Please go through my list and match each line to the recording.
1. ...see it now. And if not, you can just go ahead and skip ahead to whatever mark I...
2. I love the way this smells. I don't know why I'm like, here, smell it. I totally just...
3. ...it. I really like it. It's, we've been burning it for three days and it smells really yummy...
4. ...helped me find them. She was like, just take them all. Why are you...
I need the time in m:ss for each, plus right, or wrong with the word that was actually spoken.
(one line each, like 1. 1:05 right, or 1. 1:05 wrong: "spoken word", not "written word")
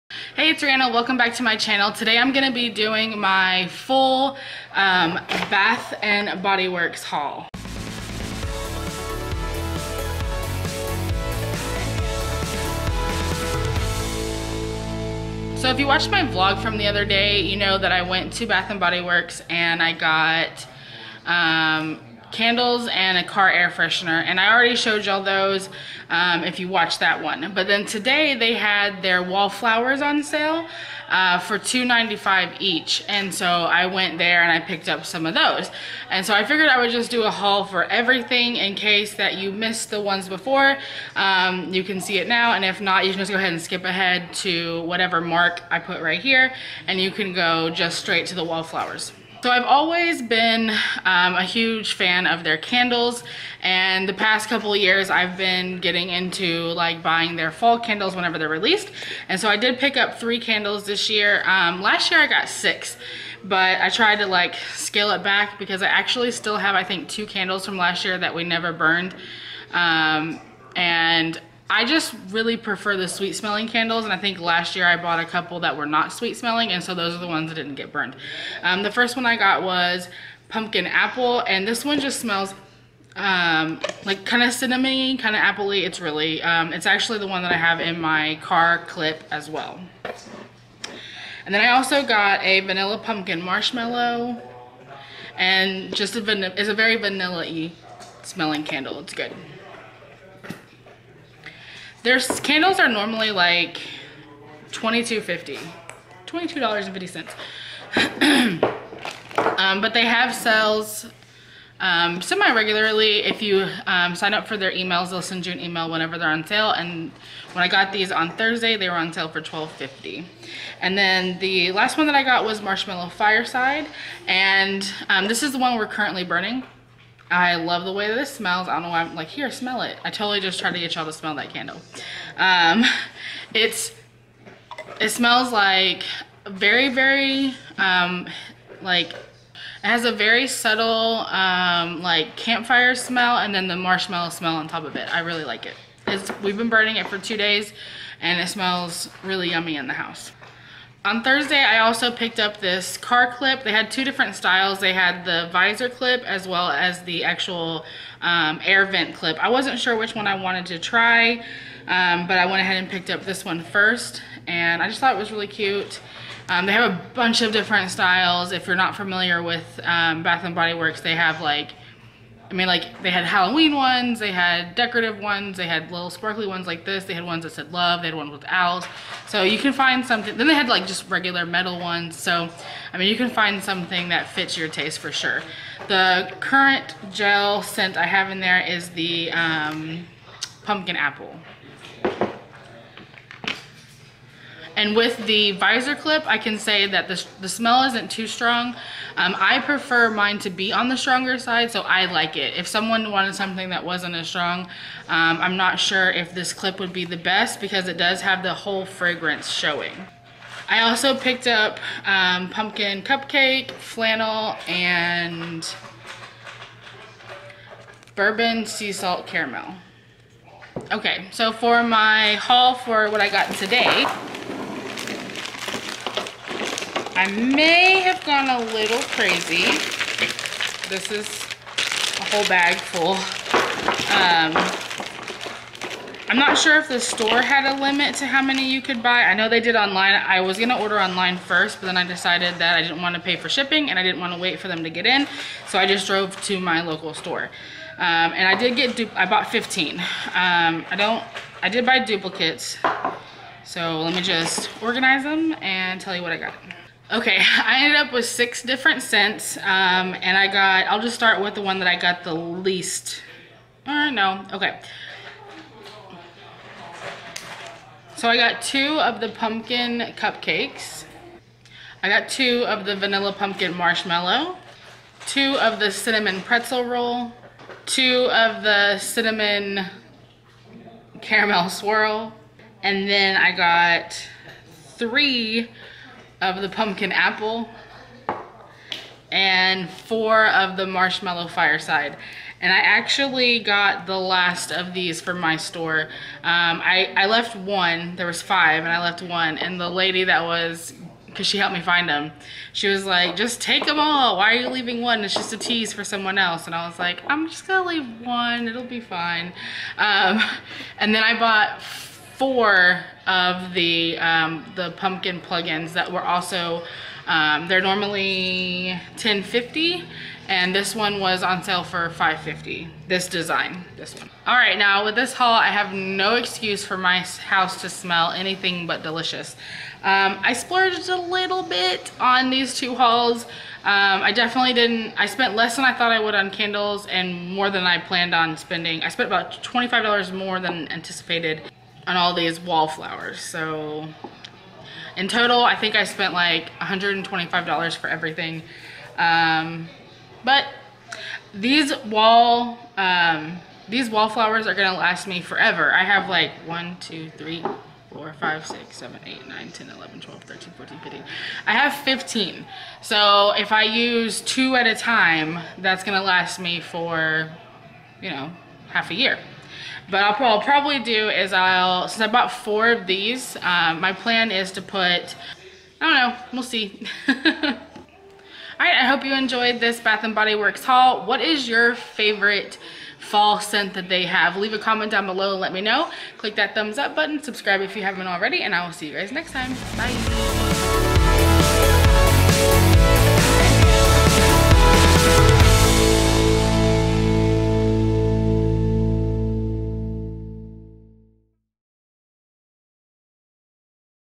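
1. 0:42 right
2. 2:07 right
3. 2:24 wrong: "two", not "three"
4. 5:01 right.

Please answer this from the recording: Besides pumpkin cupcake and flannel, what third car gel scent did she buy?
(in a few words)
bourbon sea salt caramel.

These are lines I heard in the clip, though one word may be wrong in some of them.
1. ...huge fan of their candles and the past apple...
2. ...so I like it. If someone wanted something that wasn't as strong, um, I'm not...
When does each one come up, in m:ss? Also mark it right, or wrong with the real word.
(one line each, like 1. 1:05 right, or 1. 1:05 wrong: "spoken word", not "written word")
1. 0:51 wrong: "couple", not "apple"
2. 3:21 right.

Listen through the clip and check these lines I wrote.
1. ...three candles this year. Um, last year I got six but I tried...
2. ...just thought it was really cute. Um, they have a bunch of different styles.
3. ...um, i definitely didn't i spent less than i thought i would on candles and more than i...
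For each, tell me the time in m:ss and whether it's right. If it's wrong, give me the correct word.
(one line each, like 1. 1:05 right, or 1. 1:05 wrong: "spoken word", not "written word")
1. 1:00 right
2. 2:44 right
3. 5:33 right.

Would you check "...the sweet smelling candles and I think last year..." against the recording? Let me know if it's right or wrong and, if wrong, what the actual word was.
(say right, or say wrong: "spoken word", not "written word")
right.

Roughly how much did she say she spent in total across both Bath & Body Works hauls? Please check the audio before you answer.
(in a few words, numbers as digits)
$125.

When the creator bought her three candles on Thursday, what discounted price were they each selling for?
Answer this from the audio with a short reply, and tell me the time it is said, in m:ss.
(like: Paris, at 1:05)
$12.50, at 1:59.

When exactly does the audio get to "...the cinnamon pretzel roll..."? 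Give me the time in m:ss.
4:35.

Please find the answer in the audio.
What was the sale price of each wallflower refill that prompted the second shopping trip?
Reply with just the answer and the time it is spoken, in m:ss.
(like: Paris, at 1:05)
$2.95, at 0:31.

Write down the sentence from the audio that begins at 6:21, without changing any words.
What is your favorite fall scent that they have?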